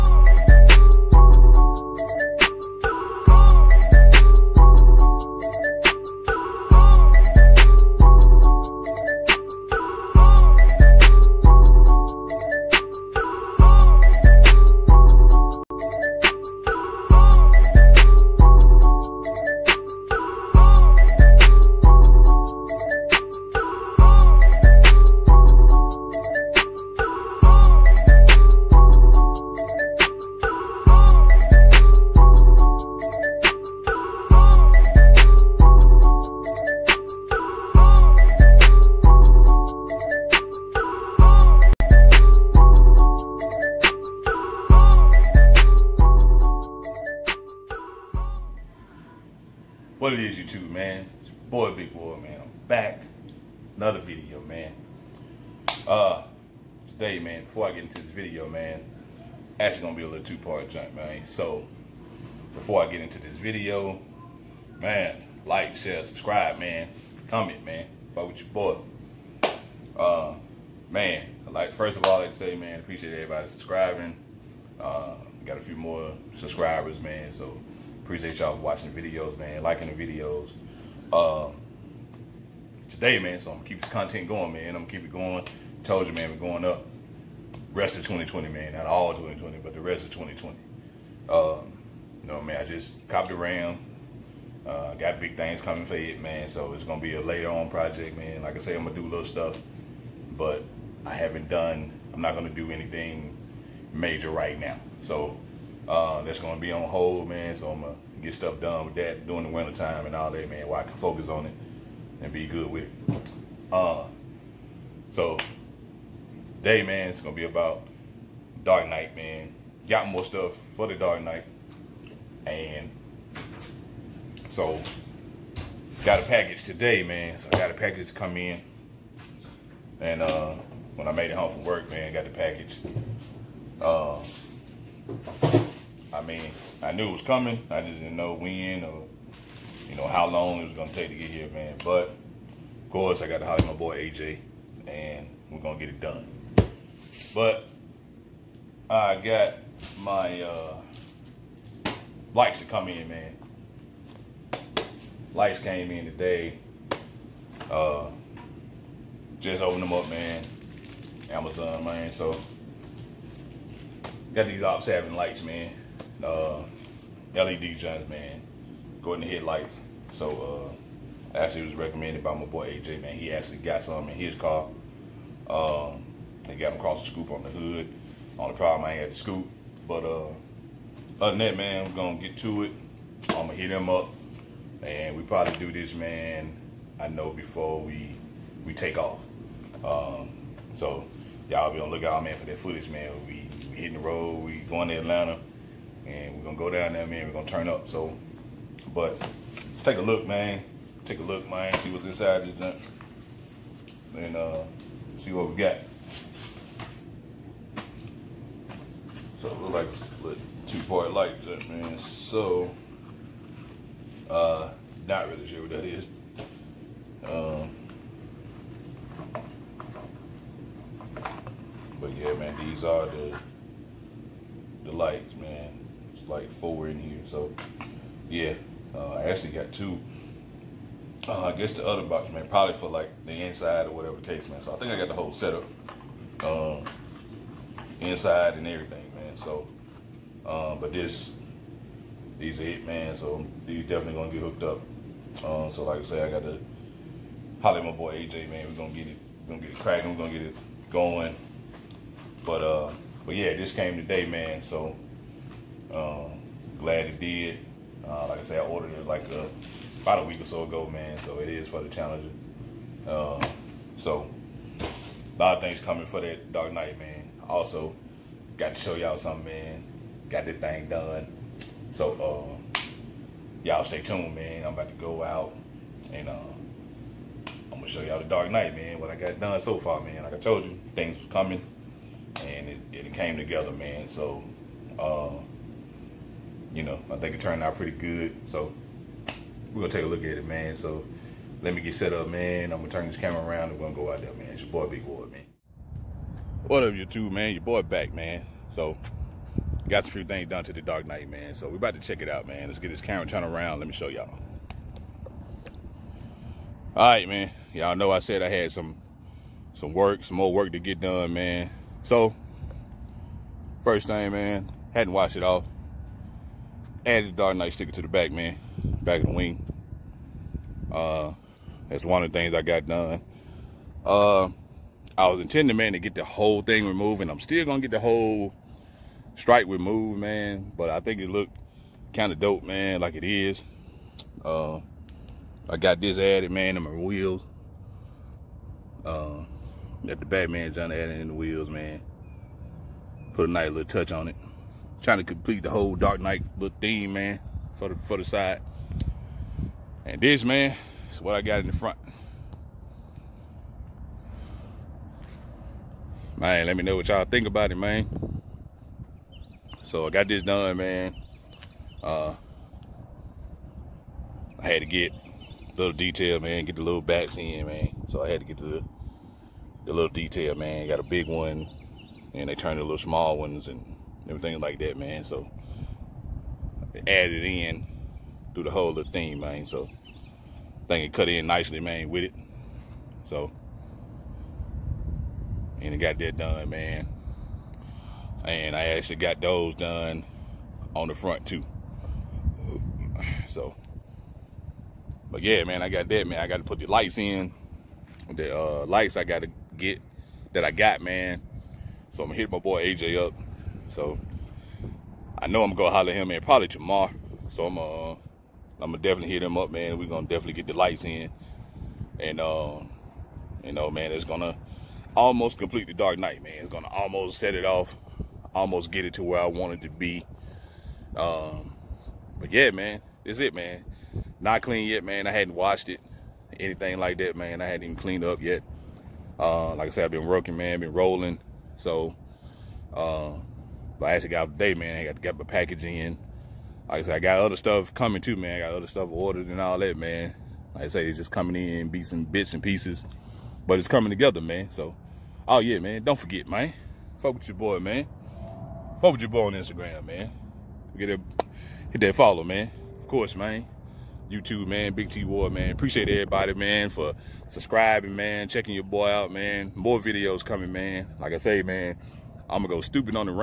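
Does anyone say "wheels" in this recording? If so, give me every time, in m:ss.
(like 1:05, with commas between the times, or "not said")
5:36, 5:41.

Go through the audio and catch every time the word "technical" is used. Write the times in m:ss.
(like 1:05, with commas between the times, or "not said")
not said.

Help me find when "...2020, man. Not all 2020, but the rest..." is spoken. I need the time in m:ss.
1:28.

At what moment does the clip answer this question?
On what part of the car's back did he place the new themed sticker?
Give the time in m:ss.
5:19.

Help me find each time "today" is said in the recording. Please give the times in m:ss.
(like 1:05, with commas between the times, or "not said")
0:56, 1:22, 2:06, 2:36, 4:13, 7:14.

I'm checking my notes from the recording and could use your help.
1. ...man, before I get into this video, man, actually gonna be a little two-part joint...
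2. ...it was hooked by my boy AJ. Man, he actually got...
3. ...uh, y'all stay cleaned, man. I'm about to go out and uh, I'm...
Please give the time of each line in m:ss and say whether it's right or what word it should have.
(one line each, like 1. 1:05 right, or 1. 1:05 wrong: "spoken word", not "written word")
1. 0:57 right
2. 2:51 wrong: "recommended", not "hooked"
3. 4:32 wrong: "tuned", not "cleaned".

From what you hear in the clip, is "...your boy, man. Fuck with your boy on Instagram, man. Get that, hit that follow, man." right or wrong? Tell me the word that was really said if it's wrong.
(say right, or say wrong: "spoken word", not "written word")
right.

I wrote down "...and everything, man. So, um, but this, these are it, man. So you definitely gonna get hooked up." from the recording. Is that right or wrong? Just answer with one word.
right.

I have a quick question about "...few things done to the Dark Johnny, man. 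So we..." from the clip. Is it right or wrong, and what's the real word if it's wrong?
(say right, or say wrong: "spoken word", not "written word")
wrong: "Knight", not "Johnny".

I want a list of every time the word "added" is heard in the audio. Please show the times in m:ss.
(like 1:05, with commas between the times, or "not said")
5:17, 5:36, 5:40, 6:17.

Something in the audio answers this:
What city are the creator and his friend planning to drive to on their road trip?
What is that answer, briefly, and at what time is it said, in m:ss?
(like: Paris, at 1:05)
Atlanta, at 3:14.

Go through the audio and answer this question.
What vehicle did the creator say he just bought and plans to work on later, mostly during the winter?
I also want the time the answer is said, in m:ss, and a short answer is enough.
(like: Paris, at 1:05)
Ram, at 1:33.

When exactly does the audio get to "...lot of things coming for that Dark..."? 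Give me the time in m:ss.
4:25.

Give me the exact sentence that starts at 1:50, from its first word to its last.
While I can focus on it and be good with it.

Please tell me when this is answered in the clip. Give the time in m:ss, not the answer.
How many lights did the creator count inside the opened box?
3:46.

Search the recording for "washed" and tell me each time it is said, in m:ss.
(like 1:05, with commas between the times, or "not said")
5:15, 7:05.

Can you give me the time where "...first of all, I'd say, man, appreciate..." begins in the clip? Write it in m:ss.
1:11.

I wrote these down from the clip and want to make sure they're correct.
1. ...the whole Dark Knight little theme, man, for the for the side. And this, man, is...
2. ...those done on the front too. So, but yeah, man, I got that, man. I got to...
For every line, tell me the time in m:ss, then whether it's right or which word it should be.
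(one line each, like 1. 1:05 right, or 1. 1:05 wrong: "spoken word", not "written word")
1. 5:45 right
2. 6:29 right.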